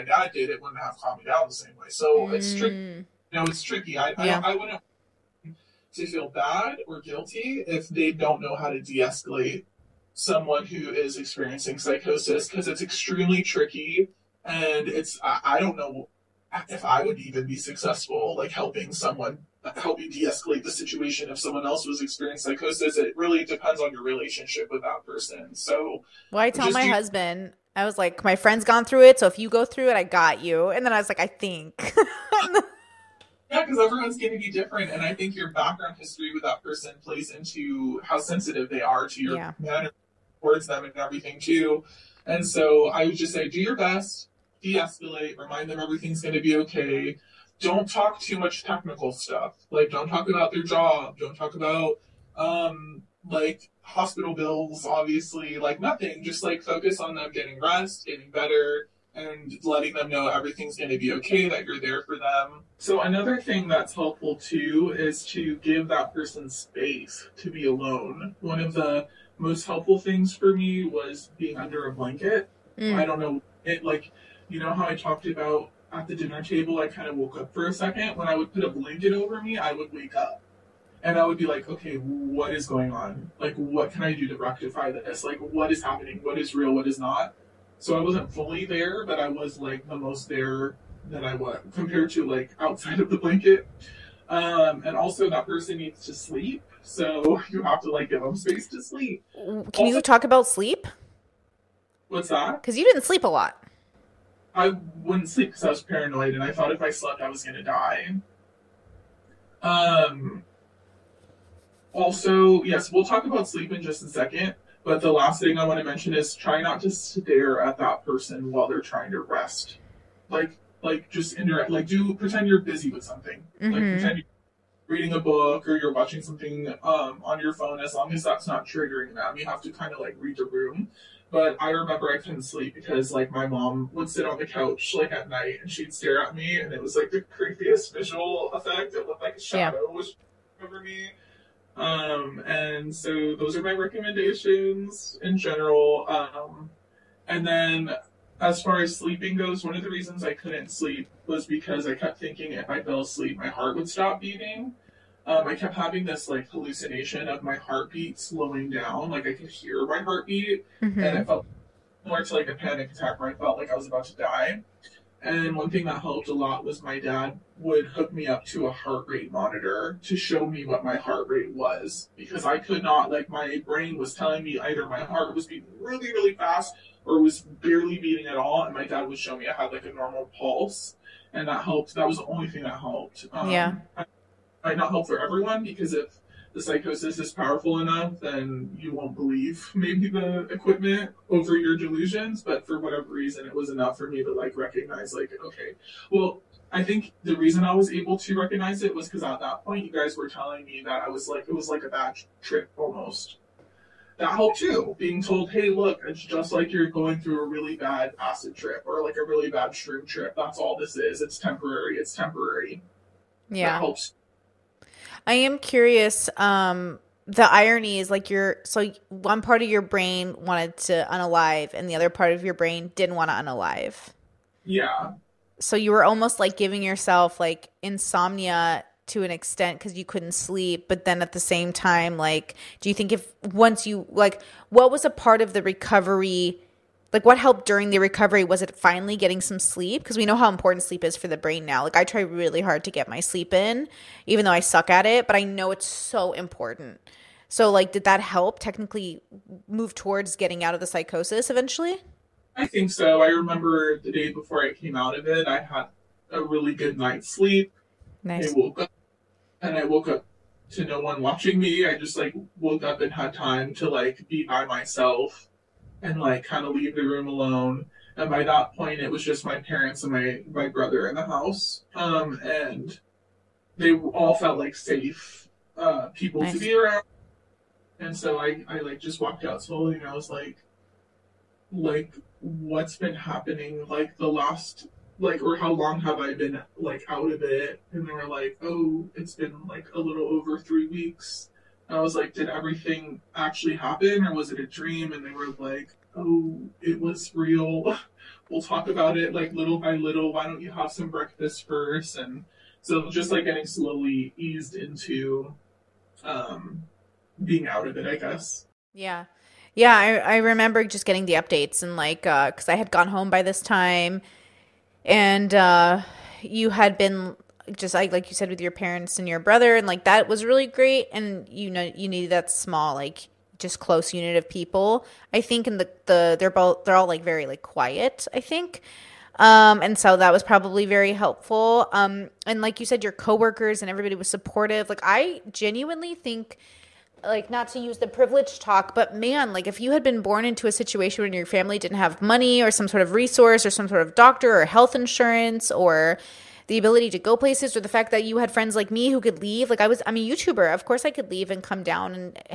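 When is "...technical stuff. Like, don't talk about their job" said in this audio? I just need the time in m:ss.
0:48.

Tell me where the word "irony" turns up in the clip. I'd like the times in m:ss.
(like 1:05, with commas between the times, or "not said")
3:37.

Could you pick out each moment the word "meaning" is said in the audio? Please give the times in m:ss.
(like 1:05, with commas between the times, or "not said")
not said.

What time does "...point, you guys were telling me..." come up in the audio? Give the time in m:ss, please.
3:19.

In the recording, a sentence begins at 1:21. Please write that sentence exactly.
And I would be like, okay, what is going on?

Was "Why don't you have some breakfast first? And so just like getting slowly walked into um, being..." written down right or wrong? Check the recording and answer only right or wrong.
wrong.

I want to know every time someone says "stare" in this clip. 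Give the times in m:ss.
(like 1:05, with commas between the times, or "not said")
1:56, 2:15.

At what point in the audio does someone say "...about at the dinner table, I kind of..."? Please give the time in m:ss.
1:15.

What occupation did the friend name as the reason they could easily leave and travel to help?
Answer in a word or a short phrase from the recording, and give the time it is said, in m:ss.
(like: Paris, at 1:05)
YouTuber, at 5:50.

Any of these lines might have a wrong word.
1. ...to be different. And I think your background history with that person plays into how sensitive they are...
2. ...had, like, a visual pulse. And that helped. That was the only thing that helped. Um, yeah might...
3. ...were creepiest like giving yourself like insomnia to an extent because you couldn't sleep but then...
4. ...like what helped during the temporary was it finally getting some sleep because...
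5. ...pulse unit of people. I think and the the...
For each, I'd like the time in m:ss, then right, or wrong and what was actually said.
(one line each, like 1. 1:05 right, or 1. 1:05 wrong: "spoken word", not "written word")
1. 0:34 right
2. 2:59 wrong: "normal", not "visual"
3. 3:45 wrong: "almost", not "creepiest"
4. 3:57 wrong: "recovery", not "temporary"
5. 5:23 wrong: "close", not "pulse".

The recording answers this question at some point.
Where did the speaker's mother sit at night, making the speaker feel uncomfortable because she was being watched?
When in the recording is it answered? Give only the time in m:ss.
2:14.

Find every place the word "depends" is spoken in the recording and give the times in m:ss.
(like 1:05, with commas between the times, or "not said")
0:23.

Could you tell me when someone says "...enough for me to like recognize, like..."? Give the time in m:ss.
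3:13.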